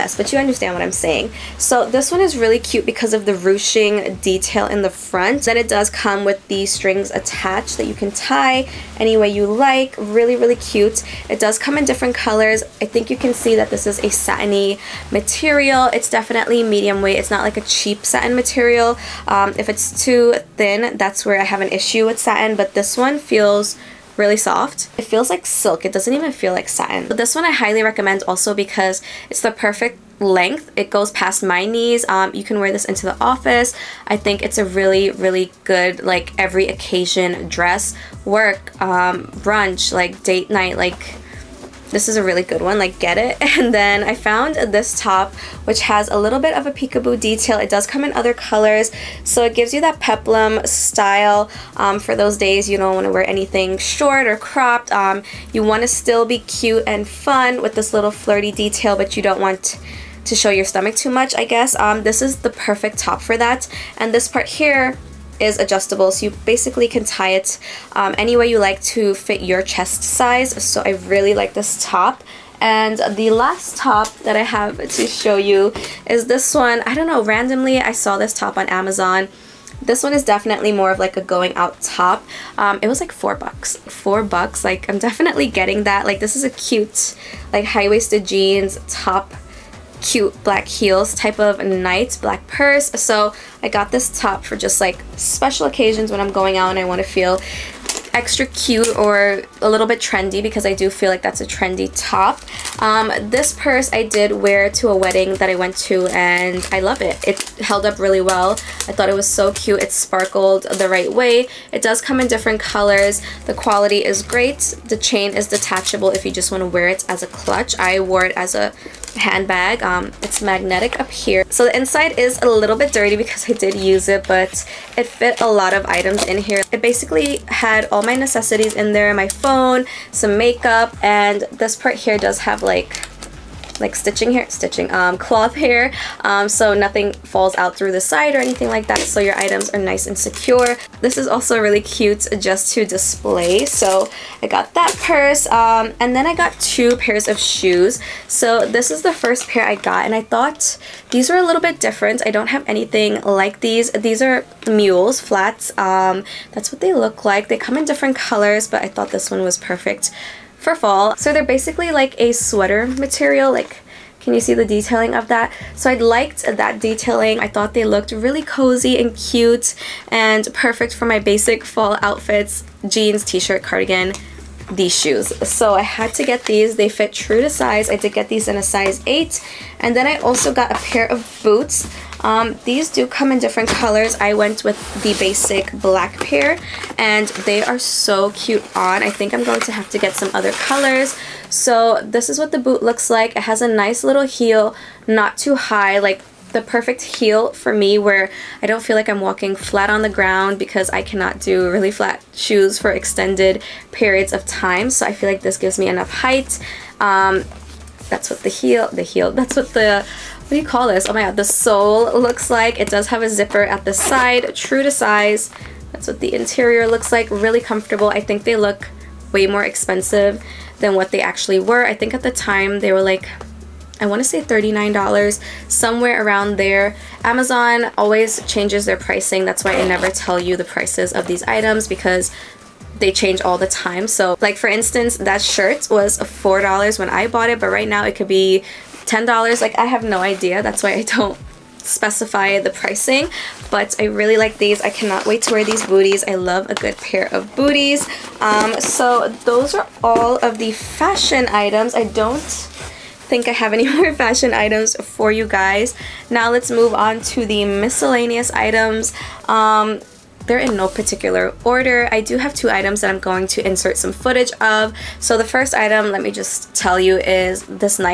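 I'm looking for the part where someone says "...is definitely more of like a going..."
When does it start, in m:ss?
1:20.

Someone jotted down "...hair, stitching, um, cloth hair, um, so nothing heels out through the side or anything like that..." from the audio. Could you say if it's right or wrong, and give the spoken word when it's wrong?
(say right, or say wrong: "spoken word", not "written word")
wrong: "falls", not "heels".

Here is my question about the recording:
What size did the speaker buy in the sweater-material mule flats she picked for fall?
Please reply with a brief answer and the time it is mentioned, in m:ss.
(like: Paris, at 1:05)
8, at 2:58.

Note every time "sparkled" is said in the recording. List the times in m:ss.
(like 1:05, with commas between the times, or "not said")
1:49.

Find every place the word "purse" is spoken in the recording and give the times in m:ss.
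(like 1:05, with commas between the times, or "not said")
1:32, 1:43, 2:25.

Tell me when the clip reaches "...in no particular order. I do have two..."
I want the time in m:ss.
4:20.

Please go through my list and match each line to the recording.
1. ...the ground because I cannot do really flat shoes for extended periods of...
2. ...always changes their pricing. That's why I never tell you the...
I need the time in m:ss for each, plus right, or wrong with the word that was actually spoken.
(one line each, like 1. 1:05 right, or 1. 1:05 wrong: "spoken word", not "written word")
1. 3:20 right
2. 3:47 right.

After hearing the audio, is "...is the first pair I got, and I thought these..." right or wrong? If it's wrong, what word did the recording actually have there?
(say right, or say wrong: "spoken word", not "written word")
right.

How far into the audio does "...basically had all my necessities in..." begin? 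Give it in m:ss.
2:06.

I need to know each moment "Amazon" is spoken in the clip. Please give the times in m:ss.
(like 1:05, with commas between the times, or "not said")
1:18, 3:47.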